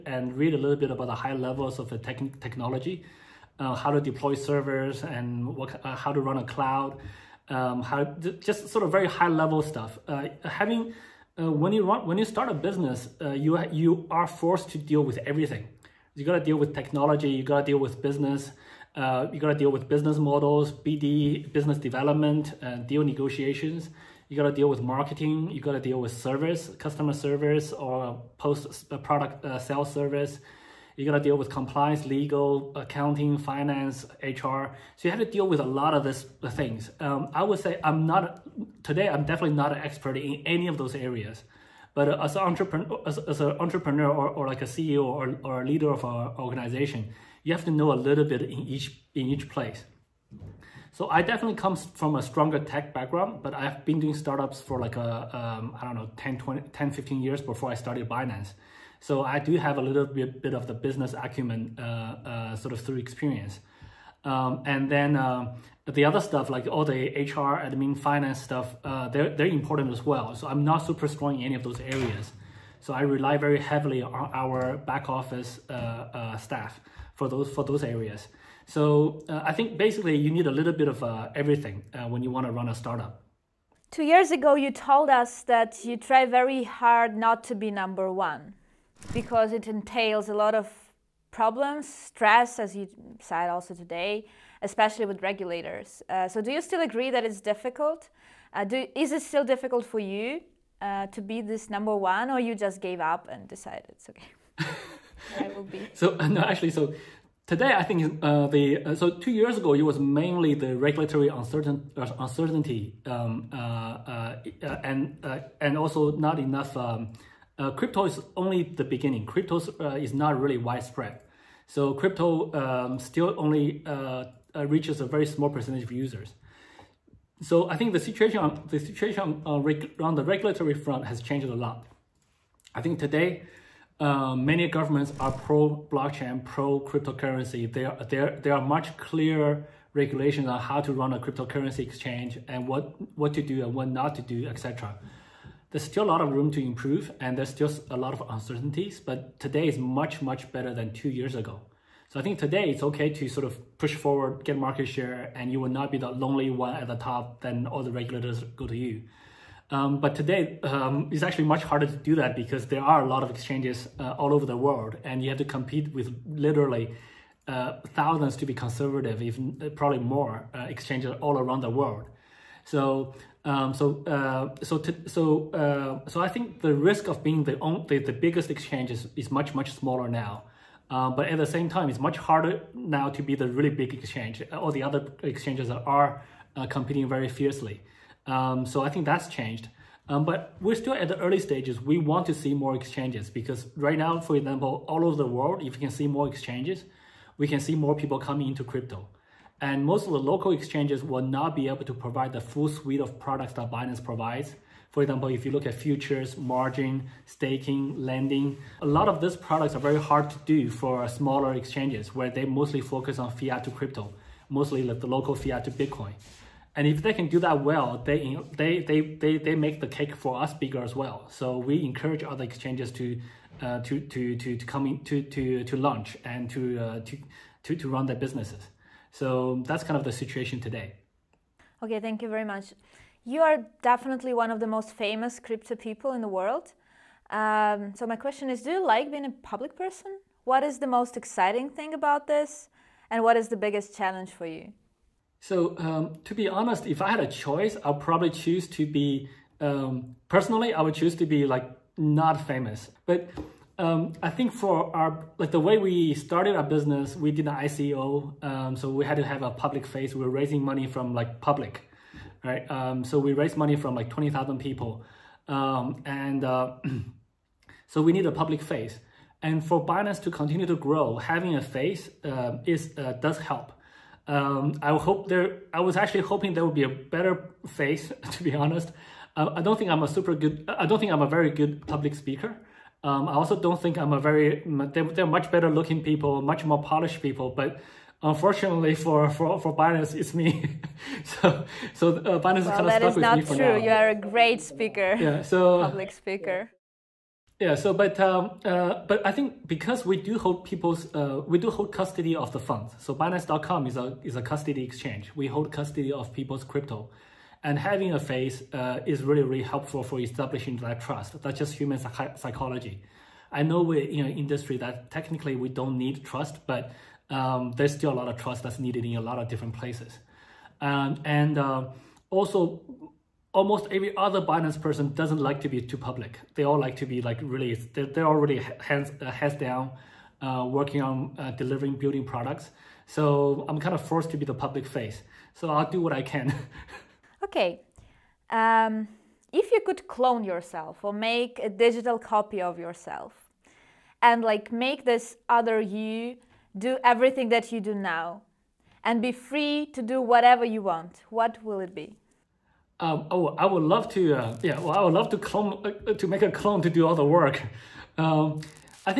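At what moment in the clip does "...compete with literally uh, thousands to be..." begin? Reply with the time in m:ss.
2:45.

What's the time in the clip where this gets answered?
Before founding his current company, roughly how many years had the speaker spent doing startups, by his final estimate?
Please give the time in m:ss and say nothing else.
0:56.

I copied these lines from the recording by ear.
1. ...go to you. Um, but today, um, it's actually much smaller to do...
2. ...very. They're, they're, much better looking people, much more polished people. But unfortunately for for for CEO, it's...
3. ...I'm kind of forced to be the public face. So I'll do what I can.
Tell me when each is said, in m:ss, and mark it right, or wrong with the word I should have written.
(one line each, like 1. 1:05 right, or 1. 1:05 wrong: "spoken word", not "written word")
1. 2:38 wrong: "harder", not "smaller"
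2. 4:44 wrong: "Binance", not "CEO"
3. 5:33 right.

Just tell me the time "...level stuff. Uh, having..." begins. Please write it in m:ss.
0:09.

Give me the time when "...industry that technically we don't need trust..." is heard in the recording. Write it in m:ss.
5:14.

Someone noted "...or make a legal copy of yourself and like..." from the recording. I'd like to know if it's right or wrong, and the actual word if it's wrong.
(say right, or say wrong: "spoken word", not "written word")
wrong: "digital", not "legal".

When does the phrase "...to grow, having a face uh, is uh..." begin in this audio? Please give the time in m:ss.
4:30.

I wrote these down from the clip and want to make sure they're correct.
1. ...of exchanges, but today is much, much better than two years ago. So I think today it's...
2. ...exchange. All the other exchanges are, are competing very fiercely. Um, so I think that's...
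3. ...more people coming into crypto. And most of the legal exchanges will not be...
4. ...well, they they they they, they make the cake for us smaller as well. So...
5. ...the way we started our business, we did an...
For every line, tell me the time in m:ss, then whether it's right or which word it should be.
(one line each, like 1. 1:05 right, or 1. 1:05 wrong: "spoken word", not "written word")
1. 2:28 wrong: "uncertainties", not "exchanges"
2. 3:03 right
3. 3:17 wrong: "local", not "legal"
4. 3:37 wrong: "bigger", not "smaller"
5. 4:15 right.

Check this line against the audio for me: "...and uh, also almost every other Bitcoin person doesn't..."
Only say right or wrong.
wrong.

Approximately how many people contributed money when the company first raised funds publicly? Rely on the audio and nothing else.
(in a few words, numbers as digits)
20,000.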